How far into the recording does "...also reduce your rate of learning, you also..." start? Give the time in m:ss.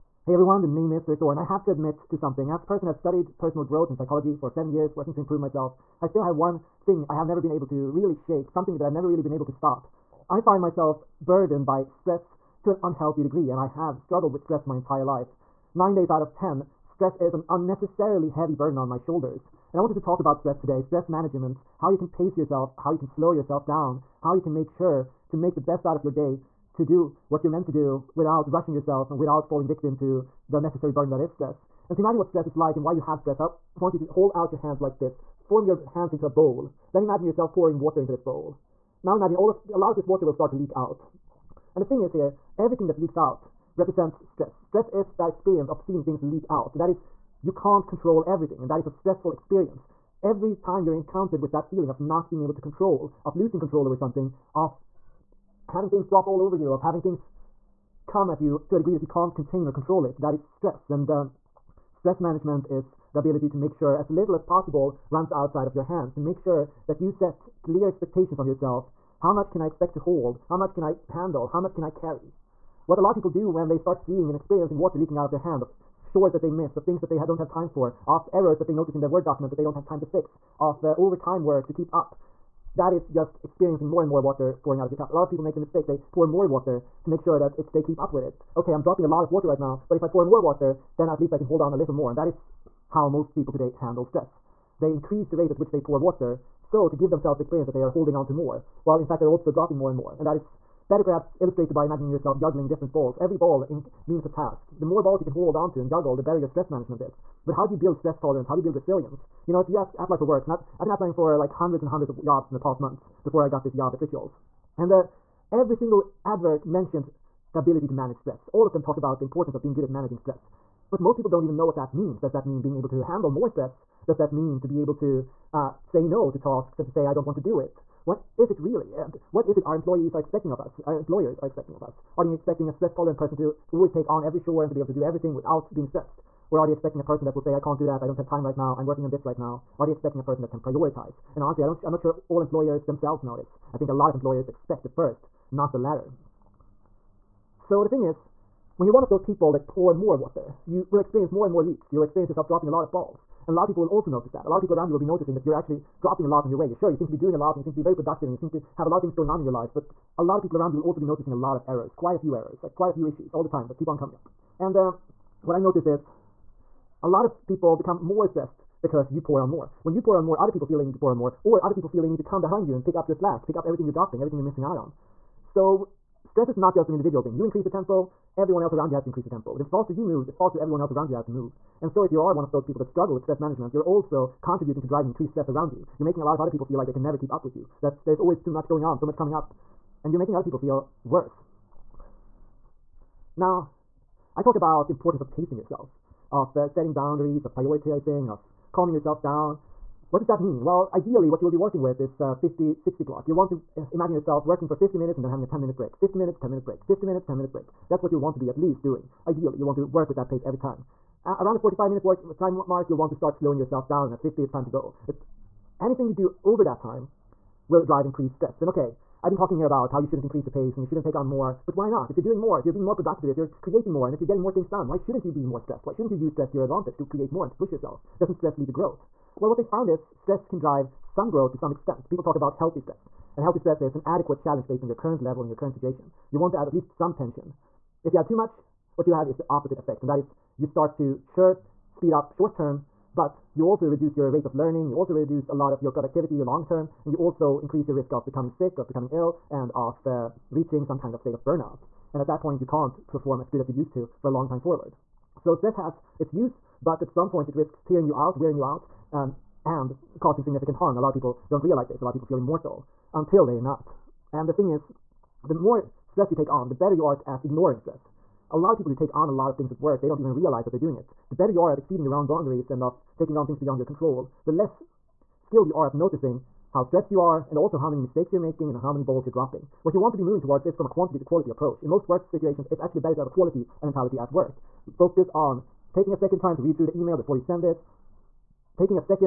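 4:03.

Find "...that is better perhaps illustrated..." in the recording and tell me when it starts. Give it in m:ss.
1:40.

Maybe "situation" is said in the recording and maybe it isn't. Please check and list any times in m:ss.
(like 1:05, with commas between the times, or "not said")
3:55, 4:42.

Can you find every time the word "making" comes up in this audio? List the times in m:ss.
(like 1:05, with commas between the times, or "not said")
3:06, 3:10, 4:38.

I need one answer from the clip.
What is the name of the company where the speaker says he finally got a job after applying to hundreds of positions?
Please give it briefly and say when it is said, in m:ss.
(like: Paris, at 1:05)
Rituals, at 1:54.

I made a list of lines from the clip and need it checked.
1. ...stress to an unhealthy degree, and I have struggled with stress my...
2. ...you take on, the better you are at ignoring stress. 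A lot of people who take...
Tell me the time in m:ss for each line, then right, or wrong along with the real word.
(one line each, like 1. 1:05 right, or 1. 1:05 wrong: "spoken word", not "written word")
1. 0:11 right
2. 4:26 right.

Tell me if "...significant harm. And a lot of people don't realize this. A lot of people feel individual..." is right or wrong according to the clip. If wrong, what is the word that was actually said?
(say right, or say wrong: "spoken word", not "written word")
wrong: "immortal", not "individual".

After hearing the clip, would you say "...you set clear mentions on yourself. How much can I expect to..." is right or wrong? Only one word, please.
wrong.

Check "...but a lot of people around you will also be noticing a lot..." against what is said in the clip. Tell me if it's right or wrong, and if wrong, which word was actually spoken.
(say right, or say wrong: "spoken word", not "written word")
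right.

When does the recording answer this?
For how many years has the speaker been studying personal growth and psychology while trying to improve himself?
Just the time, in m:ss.
0:04.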